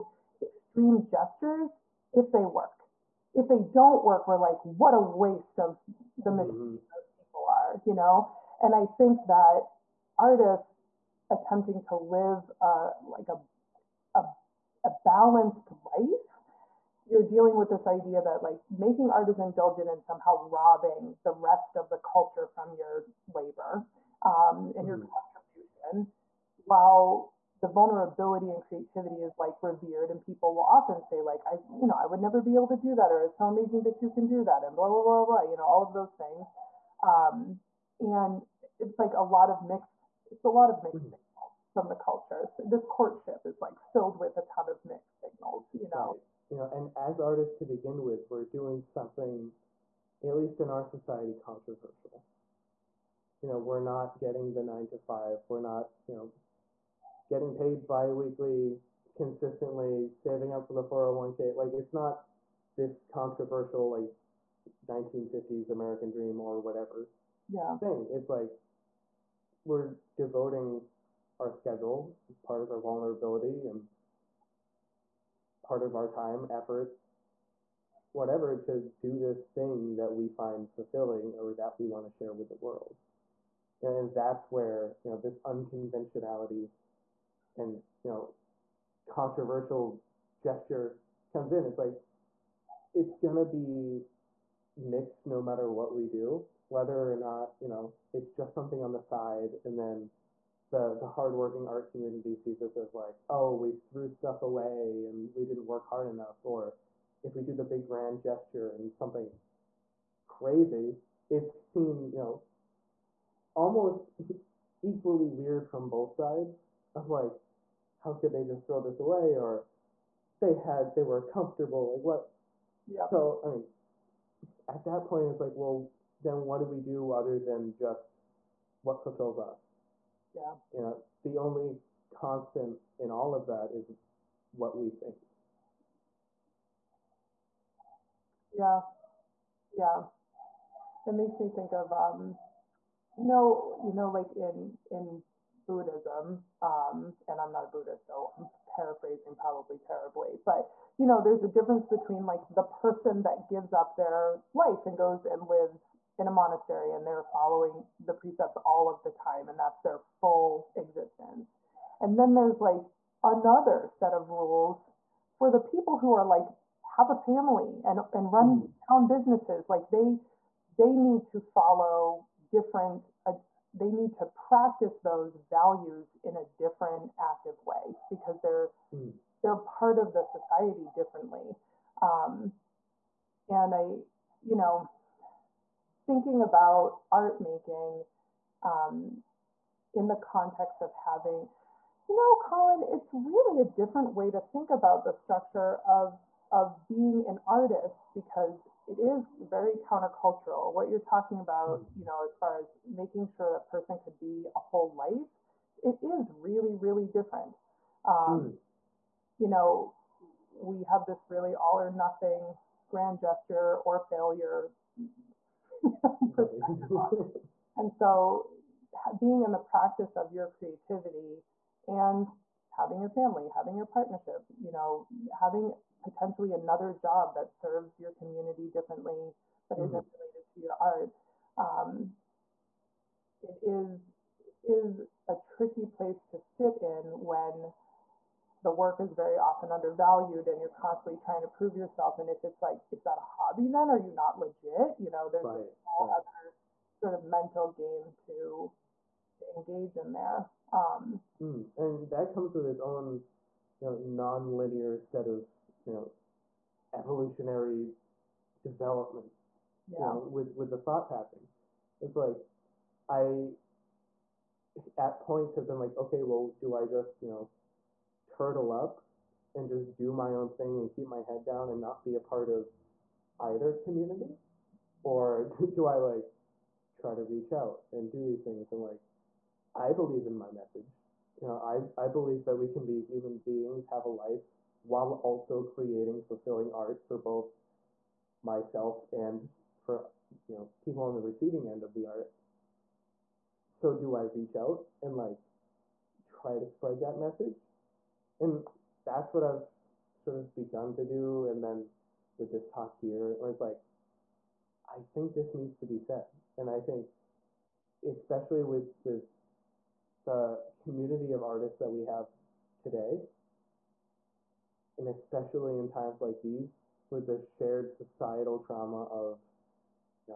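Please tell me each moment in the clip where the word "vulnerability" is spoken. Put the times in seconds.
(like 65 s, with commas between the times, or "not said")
27 s, 72 s.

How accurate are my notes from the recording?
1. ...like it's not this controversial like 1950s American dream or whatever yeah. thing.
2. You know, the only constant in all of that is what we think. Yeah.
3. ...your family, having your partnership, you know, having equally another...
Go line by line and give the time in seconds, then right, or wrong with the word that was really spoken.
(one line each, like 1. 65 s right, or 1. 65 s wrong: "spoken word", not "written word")
1. 61 s right
2. 130 s right
3. 223 s wrong: "potentially", not "equally".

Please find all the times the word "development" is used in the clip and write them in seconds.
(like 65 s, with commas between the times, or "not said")
258 s.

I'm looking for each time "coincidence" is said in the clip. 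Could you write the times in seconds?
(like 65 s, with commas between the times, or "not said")
not said.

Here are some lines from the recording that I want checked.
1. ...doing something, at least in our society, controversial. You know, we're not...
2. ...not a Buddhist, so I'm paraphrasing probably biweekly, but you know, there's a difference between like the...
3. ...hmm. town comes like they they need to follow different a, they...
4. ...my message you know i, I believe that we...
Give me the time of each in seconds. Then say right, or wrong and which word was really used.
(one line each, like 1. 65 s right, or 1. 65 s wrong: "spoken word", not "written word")
1. 48 s right
2. 147 s wrong: "terribly", not "biweekly"
3. 168 s wrong: "businesses", not "comes"
4. 280 s right.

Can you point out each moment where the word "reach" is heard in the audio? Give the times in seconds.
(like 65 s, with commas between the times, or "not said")
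277 s, 294 s.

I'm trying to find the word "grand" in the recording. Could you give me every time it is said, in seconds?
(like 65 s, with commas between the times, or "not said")
107 s, 212 s.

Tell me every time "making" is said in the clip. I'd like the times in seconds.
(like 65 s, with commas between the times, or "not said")
18 s, 187 s, 202 s.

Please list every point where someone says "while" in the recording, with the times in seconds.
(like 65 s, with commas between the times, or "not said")
26 s, 284 s.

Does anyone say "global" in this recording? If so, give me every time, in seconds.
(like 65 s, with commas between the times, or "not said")
not said.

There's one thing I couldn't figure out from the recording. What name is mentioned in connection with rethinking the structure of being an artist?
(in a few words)
Collin.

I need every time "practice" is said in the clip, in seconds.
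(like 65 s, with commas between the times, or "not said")
174 s, 219 s.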